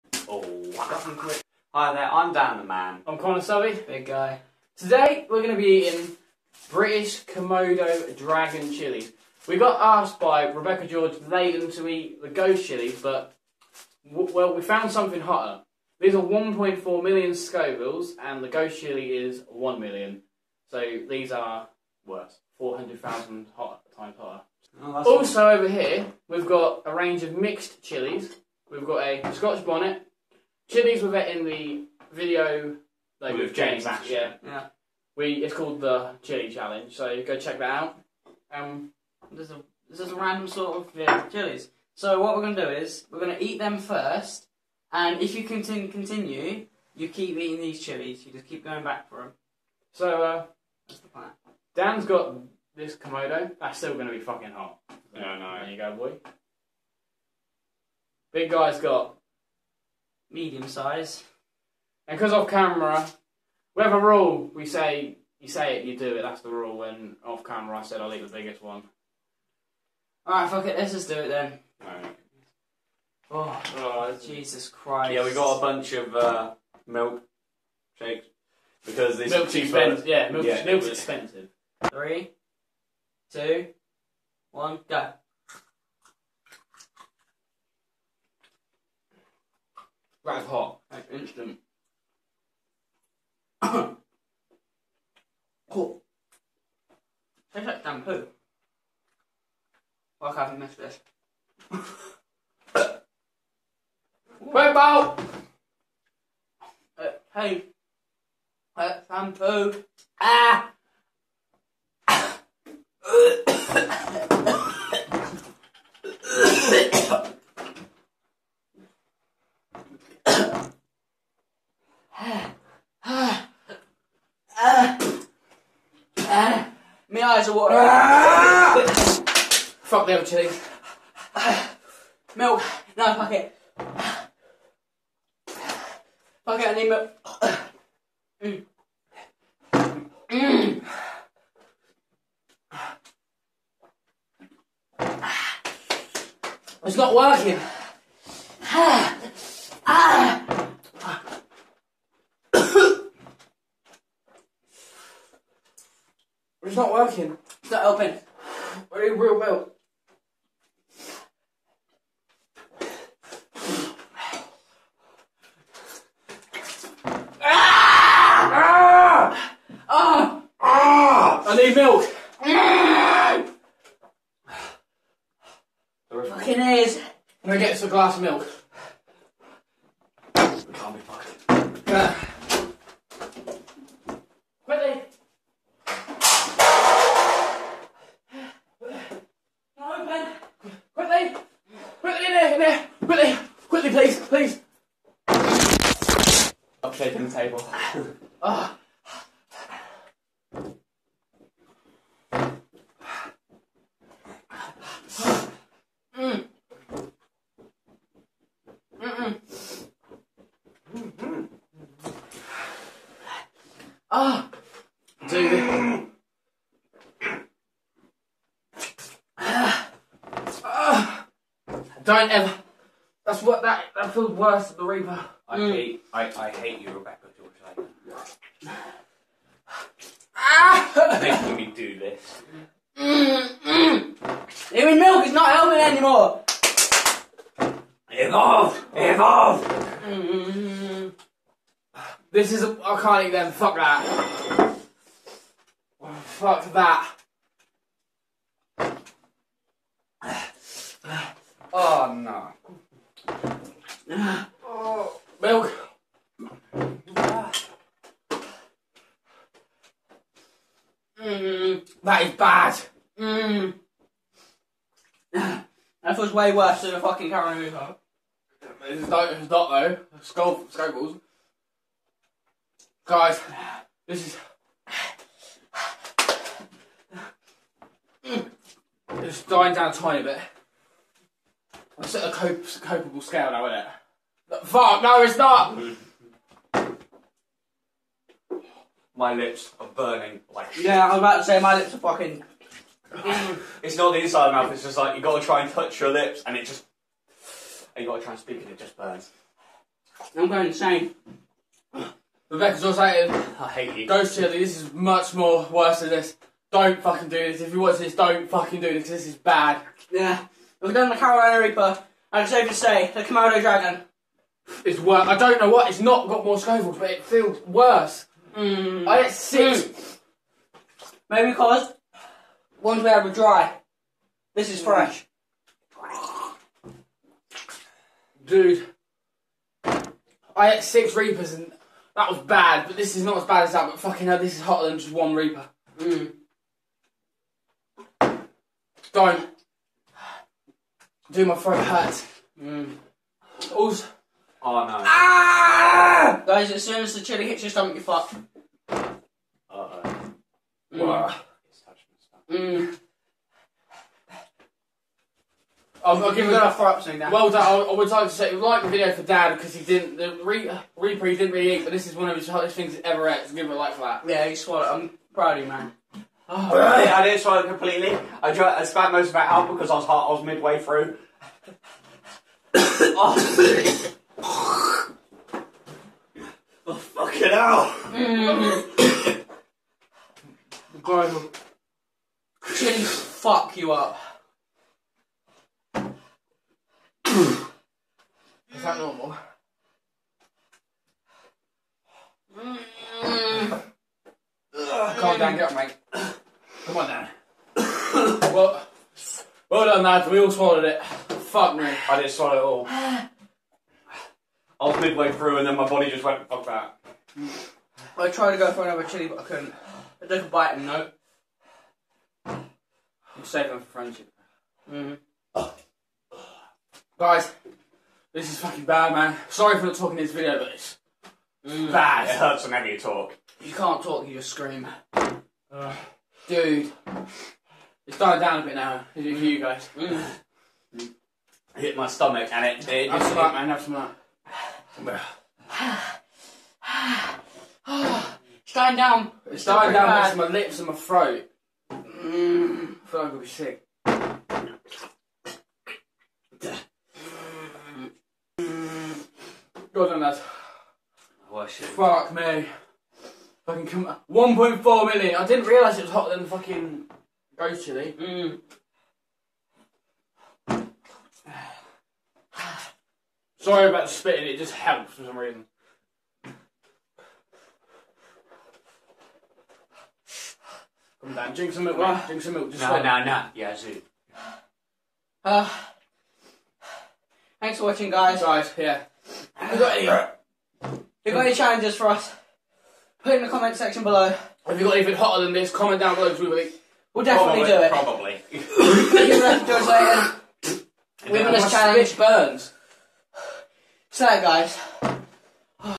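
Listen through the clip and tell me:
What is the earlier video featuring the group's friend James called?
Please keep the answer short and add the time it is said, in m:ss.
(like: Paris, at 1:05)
the Chili Challenge, at 0:36.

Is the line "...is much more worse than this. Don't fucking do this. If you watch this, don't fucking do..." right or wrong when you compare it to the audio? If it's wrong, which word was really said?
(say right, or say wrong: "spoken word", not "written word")
right.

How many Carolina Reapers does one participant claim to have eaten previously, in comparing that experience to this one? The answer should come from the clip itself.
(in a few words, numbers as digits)
6.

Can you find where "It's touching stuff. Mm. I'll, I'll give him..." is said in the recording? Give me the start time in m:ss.
5:51.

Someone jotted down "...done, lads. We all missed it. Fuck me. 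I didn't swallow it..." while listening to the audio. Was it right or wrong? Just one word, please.
wrong.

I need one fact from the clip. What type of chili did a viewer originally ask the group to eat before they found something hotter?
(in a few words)
ghost chillies.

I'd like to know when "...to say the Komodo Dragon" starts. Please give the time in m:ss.
5:12.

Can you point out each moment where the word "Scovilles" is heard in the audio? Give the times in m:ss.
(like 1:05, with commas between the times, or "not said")
0:17, 4:30, 5:16.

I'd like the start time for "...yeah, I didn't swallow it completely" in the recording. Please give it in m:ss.
6:07.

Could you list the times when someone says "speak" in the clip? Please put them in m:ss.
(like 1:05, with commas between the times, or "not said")
4:58.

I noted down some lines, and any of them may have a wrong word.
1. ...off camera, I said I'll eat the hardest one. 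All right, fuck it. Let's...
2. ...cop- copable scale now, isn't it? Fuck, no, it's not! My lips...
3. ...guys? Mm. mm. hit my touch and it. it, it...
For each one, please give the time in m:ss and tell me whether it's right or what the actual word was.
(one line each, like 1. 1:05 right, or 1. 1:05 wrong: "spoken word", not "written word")
1. 1:07 wrong: "biggest", not "hardest"
2. 4:42 right
3. 7:09 wrong: "stomach", not "touch".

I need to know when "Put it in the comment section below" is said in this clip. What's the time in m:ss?
8:03.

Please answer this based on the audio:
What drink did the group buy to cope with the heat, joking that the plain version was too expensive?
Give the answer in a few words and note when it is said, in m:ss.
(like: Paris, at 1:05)
milk shakes, at 1:16.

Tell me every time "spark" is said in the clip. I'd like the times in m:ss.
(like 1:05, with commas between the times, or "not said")
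not said.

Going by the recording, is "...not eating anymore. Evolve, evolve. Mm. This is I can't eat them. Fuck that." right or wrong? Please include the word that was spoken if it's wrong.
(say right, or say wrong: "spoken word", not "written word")
wrong: "helping", not "eating".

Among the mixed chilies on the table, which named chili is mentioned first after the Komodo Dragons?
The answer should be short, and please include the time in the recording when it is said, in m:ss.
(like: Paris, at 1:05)
Scotch bonnet, at 0:29.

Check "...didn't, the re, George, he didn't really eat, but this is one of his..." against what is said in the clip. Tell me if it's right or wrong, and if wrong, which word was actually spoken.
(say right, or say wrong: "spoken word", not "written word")
wrong: "Reaper", not "George".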